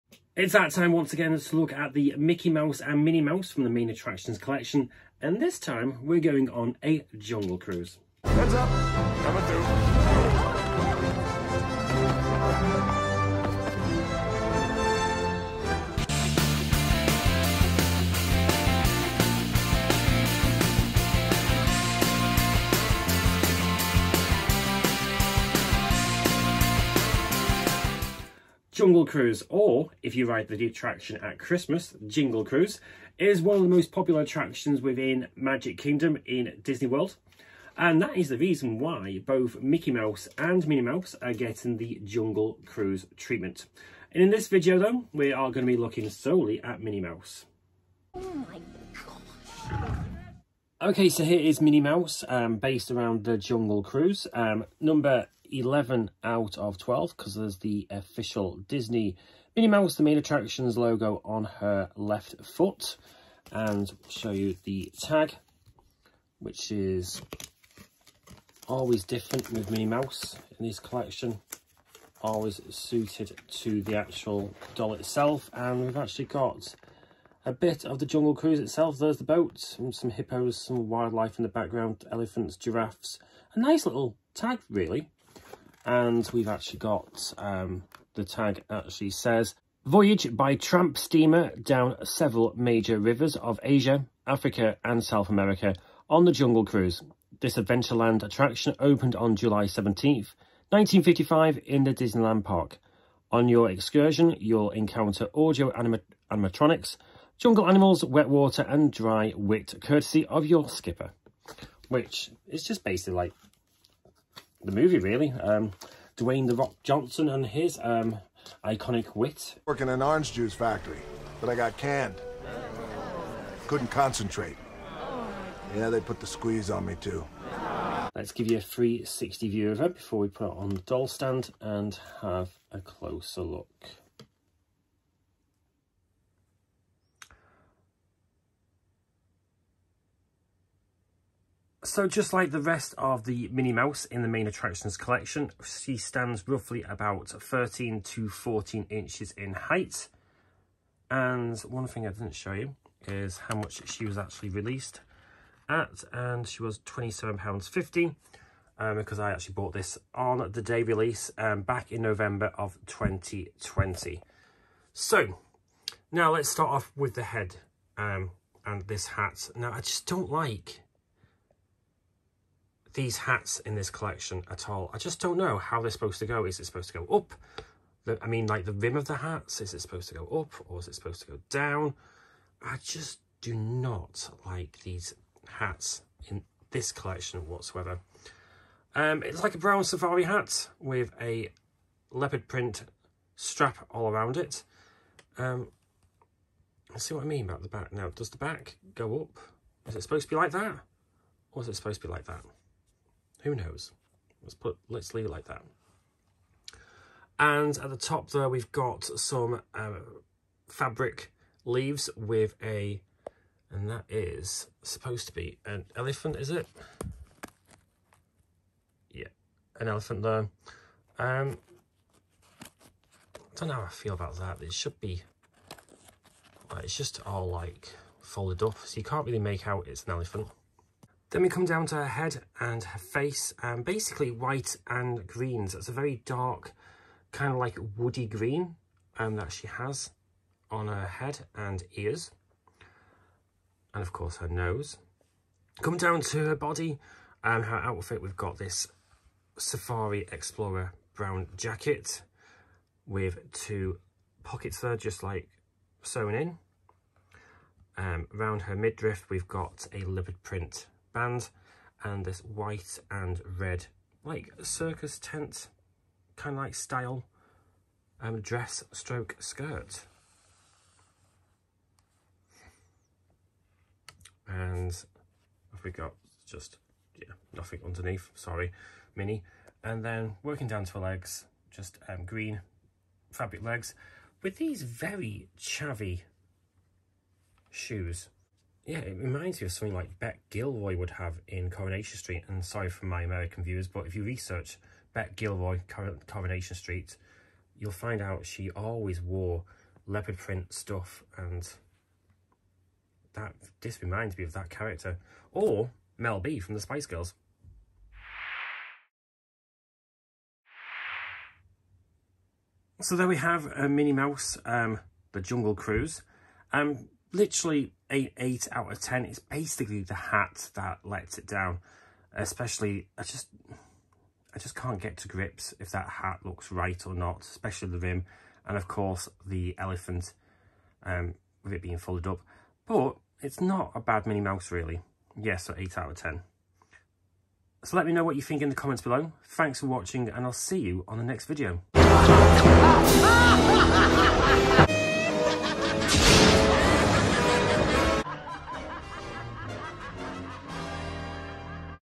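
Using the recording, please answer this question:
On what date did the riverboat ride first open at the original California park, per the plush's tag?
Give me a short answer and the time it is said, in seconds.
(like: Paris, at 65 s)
July 17th, 1955, at 99 s.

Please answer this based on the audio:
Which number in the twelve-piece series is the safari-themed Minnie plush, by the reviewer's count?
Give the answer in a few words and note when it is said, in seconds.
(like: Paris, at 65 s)
11, at 54 s.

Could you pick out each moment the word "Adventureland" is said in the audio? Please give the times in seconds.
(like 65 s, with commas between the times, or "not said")
97 s.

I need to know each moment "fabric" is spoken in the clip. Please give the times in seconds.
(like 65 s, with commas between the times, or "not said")
210 s, 283 s.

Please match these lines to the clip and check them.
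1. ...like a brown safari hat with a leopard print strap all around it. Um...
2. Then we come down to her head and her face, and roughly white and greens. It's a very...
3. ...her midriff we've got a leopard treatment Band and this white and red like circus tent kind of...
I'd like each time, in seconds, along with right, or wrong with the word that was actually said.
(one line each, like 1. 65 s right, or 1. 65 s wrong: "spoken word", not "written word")
1. 189 s right
2. 231 s wrong: "basically", not "roughly"
3. 258 s wrong: "print", not "treatment".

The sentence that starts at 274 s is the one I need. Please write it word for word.
And have we got just yeah nothing underneath, sorry, Minnie.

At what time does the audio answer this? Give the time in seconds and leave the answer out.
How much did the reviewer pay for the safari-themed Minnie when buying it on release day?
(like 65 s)
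156 s.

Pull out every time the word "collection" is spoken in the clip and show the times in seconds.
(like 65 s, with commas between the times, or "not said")
4 s, 70 s, 144 s, 173 s, 186 s.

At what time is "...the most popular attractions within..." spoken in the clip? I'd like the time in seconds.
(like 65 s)
33 s.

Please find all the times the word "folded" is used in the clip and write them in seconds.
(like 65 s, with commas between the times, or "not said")
228 s, 331 s.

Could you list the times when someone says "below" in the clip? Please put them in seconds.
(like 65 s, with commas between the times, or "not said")
339 s.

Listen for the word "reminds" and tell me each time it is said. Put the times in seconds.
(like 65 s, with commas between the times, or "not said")
289 s, 304 s.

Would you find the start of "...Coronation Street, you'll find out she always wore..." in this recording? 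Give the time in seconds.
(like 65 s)
296 s.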